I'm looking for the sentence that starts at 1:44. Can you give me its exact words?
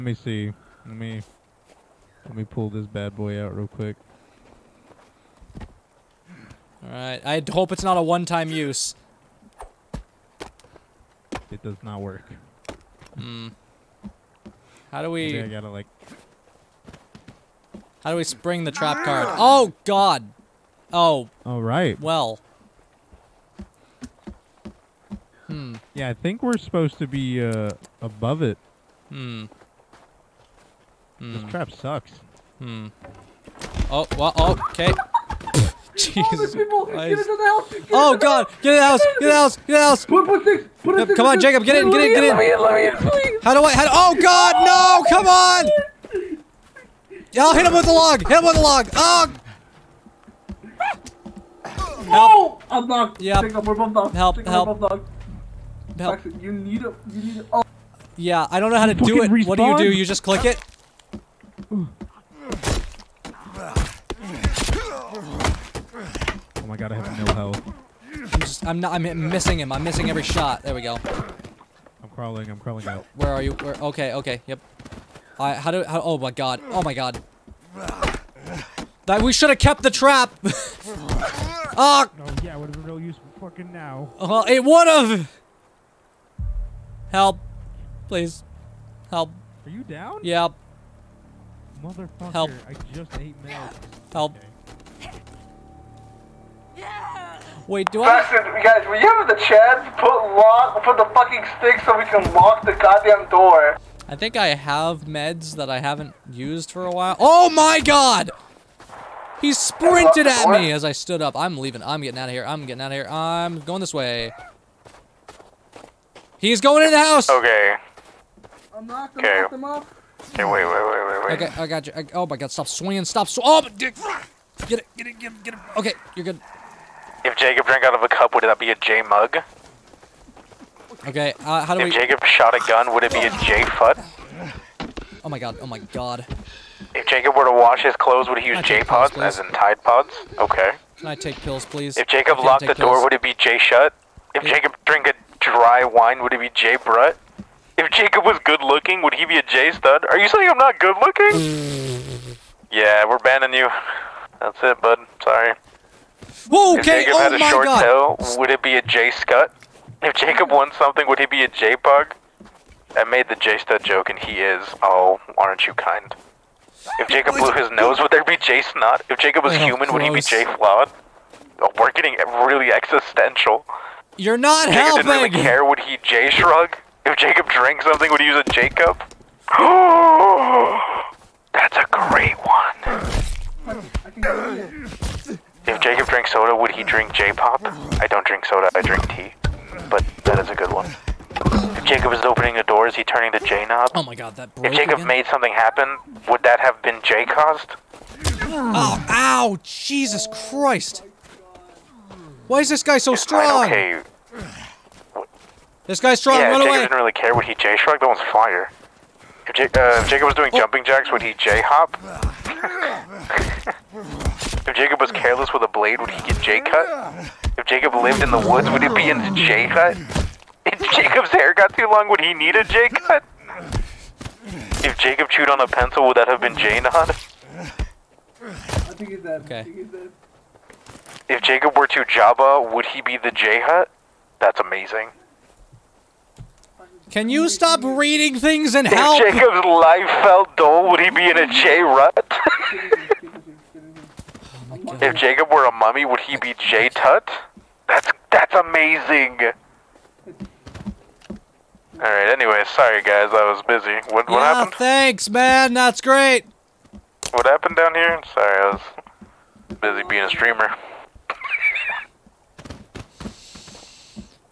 I think I have meds that I haven't used for a while.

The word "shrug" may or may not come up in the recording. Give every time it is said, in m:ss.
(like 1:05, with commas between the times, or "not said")
2:56, 3:27.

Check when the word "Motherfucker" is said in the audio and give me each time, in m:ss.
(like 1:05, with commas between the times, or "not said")
1:31.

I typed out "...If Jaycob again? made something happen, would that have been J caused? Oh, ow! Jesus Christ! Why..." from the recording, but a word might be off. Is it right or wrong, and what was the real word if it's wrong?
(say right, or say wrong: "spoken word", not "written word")
right.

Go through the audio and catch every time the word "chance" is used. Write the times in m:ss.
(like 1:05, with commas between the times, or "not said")
1:39.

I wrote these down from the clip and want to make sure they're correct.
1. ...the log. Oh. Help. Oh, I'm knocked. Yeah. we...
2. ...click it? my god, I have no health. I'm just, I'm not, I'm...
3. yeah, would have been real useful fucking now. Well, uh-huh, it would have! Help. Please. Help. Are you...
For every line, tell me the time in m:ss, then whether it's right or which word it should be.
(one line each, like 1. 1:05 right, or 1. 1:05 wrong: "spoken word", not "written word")
1. 0:48 right
2. 1:00 right
3. 1:22 right.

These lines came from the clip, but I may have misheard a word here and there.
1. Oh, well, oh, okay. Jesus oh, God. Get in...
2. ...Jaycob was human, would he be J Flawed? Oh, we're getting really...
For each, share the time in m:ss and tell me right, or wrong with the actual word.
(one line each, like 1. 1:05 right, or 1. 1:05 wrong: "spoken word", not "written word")
1. 0:33 right
2. 2:49 right.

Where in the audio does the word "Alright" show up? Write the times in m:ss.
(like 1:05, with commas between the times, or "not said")
0:06, 0:21.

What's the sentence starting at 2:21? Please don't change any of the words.
If Jaycob locked the door, would it be J shut?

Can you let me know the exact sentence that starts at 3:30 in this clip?
jumping jacks, would he J hop?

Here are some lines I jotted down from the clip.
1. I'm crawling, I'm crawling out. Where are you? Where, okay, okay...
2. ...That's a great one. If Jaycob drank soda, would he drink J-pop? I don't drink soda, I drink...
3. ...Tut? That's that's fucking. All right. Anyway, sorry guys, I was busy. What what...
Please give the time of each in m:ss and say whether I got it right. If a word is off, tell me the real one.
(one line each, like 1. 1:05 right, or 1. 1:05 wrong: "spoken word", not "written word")
1. 1:12 right
2. 3:01 right
3. 4:06 wrong: "amazing", not "fucking".